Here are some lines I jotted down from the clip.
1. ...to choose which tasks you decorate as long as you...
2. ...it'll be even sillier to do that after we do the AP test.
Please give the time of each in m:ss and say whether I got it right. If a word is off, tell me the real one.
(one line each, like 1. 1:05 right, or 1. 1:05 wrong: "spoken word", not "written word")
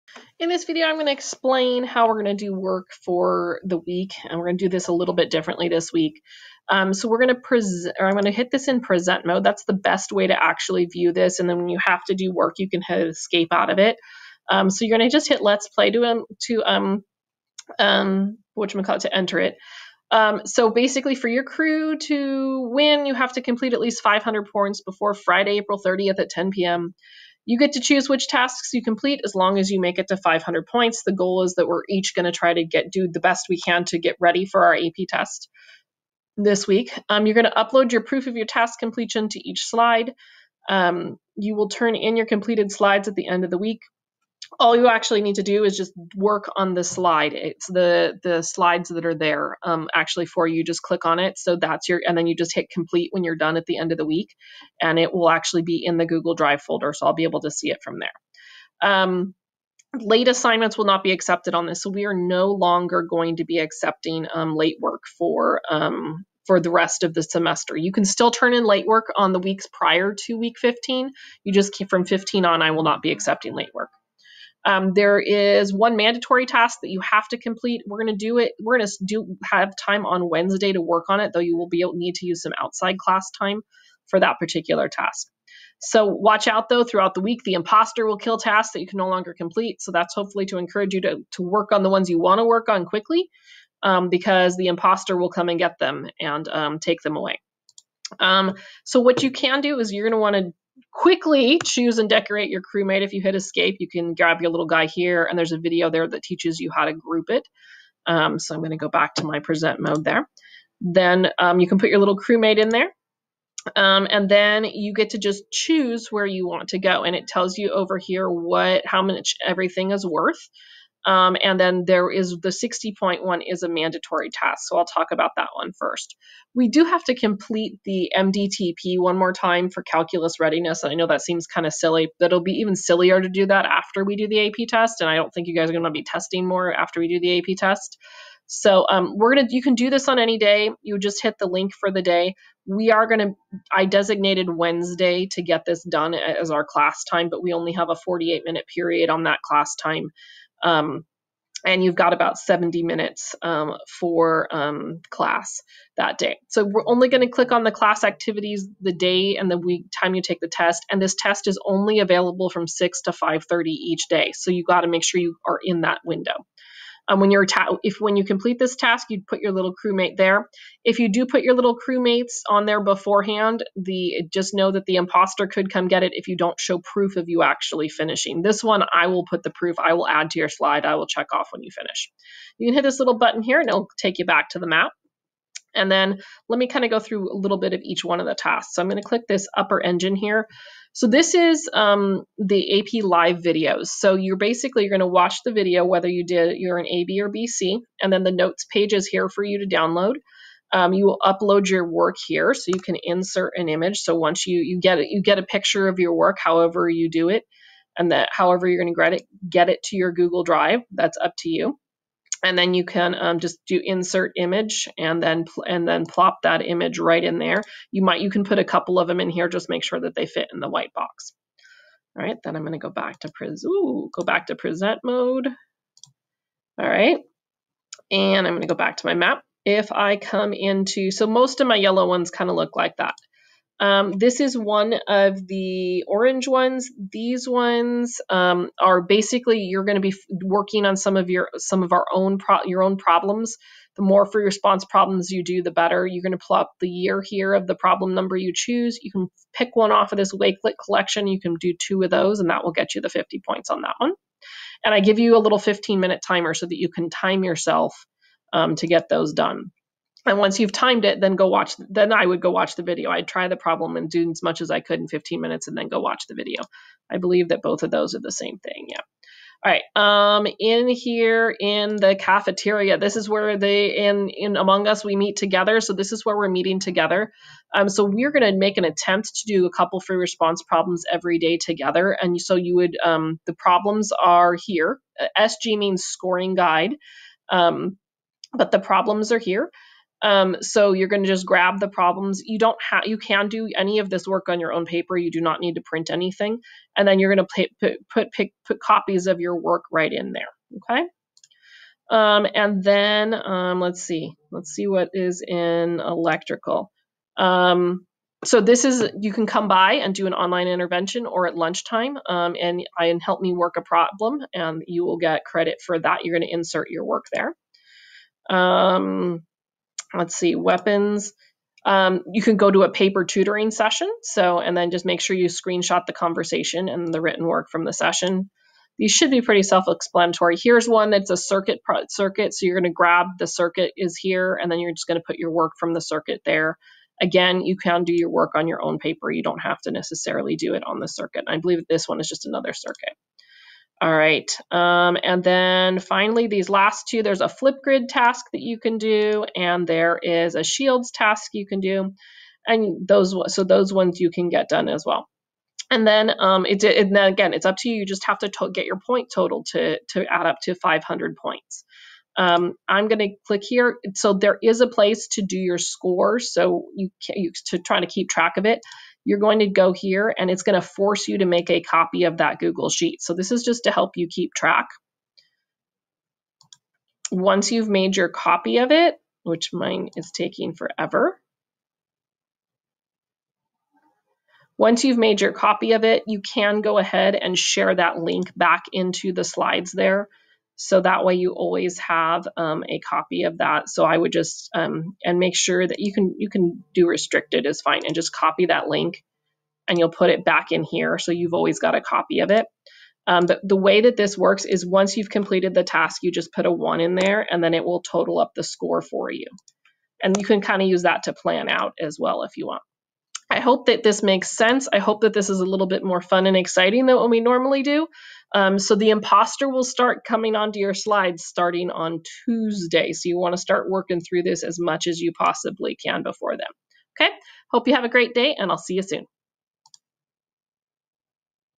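1. 0:27 wrong: "complete", not "decorate"
2. 2:12 right.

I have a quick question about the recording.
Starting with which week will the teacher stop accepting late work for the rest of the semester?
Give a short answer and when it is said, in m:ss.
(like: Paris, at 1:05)
Week 15, at 1:10.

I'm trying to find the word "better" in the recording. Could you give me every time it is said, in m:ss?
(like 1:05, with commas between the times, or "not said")
4:05.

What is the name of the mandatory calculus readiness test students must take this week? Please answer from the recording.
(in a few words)
MDTP.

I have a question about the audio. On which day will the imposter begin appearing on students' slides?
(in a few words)
Tuesday.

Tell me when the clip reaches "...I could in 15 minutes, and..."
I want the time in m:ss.
4:24.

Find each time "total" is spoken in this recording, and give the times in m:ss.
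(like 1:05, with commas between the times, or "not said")
5:59, 6:48.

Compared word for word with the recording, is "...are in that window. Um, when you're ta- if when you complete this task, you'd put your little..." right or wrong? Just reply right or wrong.
right.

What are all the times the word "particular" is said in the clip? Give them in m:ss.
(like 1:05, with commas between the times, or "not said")
1:24.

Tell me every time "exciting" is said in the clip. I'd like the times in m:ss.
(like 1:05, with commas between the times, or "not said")
6:56.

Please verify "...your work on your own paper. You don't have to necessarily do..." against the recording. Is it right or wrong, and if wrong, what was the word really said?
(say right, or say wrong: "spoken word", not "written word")
right.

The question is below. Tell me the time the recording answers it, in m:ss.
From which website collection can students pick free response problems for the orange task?
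4:10.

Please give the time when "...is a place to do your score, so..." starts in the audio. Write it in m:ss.
6:04.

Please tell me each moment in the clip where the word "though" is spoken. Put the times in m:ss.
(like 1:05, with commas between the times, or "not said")
1:21, 1:26.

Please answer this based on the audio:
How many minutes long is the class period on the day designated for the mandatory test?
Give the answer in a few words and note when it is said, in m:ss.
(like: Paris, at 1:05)
48, at 2:27.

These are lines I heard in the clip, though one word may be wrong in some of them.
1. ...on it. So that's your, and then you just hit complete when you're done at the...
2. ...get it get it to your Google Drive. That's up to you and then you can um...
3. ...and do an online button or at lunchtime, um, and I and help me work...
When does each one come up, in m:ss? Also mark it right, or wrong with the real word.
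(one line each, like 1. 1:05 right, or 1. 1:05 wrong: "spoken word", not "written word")
1. 0:51 right
2. 3:28 right
3. 5:09 wrong: "intervention", not "button".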